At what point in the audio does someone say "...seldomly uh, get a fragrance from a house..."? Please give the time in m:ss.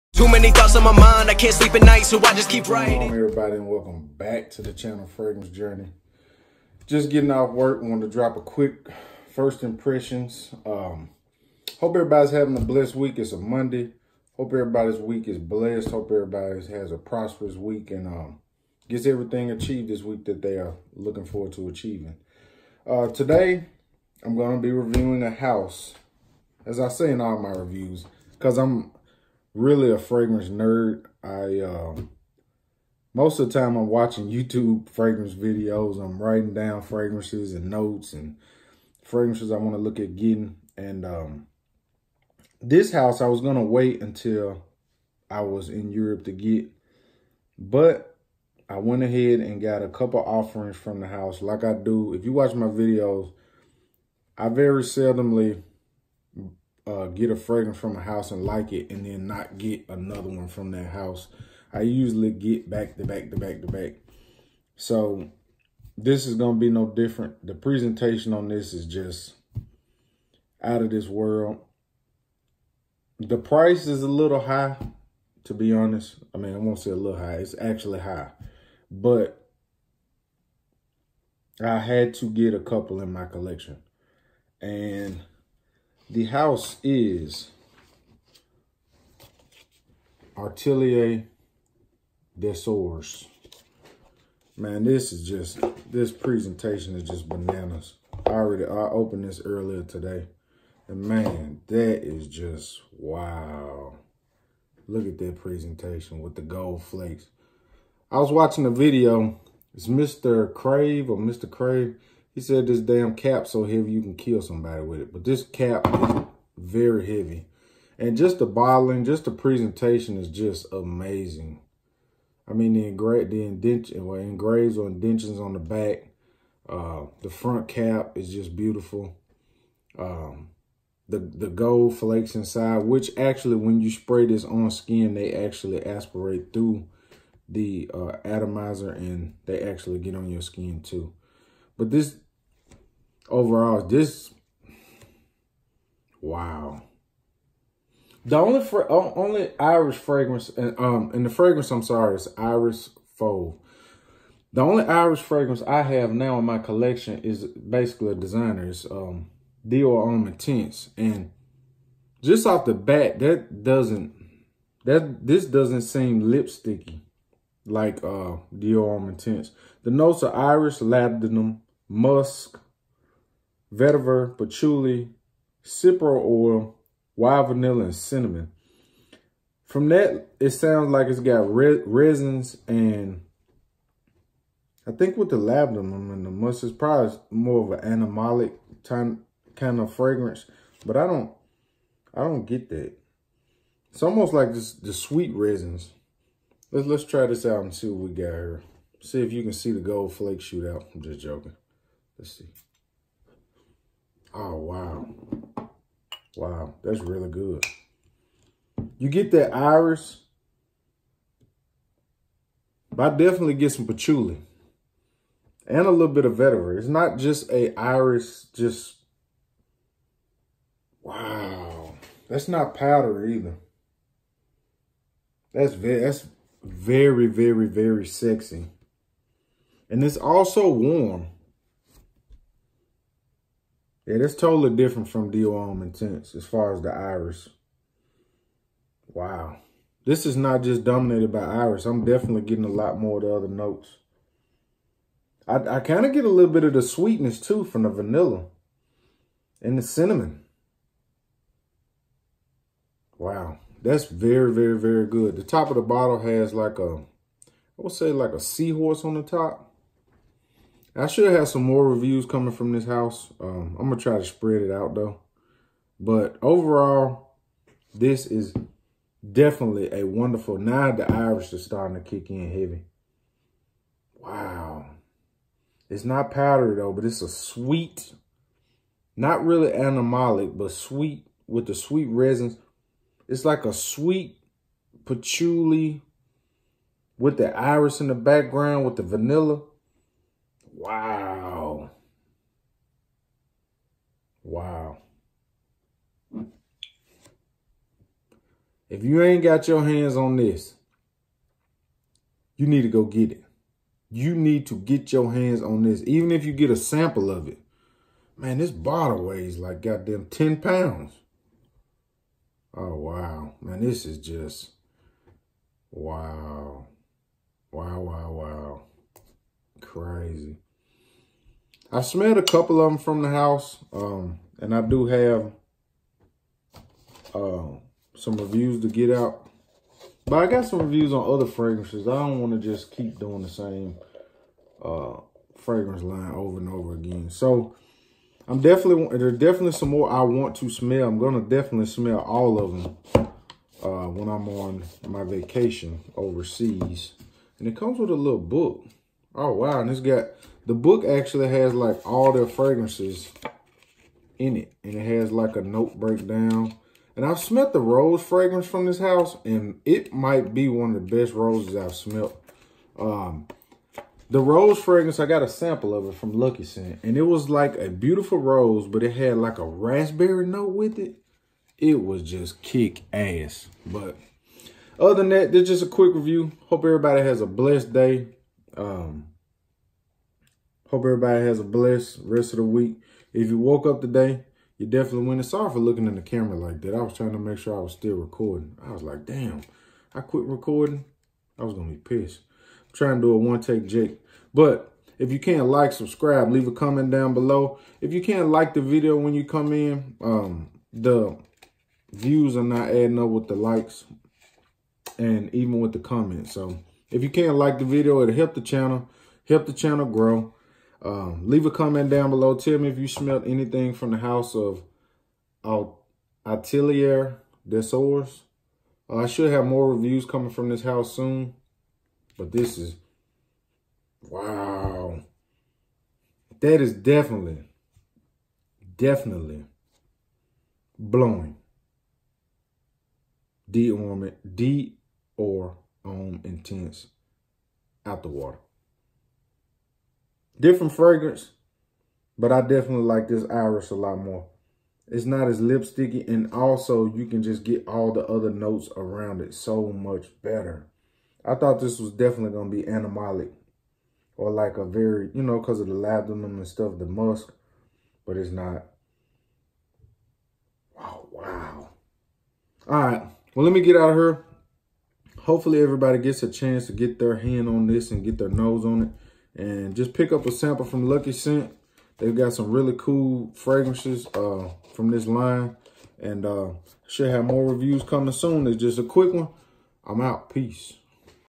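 0:54.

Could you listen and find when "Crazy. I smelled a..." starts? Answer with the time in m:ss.
5:19.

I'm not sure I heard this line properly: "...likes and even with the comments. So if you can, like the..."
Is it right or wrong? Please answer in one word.
right.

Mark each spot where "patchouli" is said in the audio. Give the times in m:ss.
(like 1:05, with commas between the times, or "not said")
2:54, 3:33, 4:45.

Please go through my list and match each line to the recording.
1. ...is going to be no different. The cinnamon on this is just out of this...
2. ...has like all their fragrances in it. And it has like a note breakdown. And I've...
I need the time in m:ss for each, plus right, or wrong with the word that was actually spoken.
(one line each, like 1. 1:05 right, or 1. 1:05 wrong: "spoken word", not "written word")
1. 1:06 wrong: "presentation", not "cinnamon"
2. 5:51 right.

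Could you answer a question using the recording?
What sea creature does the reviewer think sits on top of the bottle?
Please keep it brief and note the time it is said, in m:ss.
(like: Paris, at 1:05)
a seahorse, at 4:18.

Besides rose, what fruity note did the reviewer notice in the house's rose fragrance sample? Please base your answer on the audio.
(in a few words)
raspberry.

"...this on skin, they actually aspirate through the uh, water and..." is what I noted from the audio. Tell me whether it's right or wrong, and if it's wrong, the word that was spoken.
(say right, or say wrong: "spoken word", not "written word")
wrong: "atomizer", not "water".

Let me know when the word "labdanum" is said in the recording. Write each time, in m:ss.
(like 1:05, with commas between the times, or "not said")
2:50, 3:05, 7:35.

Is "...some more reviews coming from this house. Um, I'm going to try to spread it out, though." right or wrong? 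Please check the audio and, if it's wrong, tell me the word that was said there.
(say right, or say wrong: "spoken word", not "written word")
right.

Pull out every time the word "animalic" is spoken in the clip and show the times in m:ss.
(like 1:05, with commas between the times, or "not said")
3:08, 4:39, 7:32.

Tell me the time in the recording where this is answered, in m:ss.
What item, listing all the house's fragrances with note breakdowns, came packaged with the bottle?
5:48.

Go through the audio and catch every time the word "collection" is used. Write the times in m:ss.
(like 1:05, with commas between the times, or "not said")
1:23, 2:36.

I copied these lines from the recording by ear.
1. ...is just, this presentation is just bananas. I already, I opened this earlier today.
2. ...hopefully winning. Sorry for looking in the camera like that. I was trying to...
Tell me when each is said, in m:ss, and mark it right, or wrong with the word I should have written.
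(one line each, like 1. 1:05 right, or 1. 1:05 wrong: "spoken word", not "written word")
1. 1:35 right
2. 6:24 wrong: "definitely", not "hopefully".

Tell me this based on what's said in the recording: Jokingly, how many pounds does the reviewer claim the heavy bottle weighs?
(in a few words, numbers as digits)
10.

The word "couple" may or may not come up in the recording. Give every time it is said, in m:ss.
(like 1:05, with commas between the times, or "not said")
0:49, 1:22, 5:22.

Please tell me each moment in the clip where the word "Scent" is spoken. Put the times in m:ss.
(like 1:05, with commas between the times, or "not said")
6:06, 7:51.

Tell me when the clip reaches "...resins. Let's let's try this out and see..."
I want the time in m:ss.
3:15.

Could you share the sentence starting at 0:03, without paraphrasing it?
everybody and welcome back to the channel Fragrance Journey.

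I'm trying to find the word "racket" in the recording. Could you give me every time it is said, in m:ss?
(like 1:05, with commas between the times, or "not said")
not said.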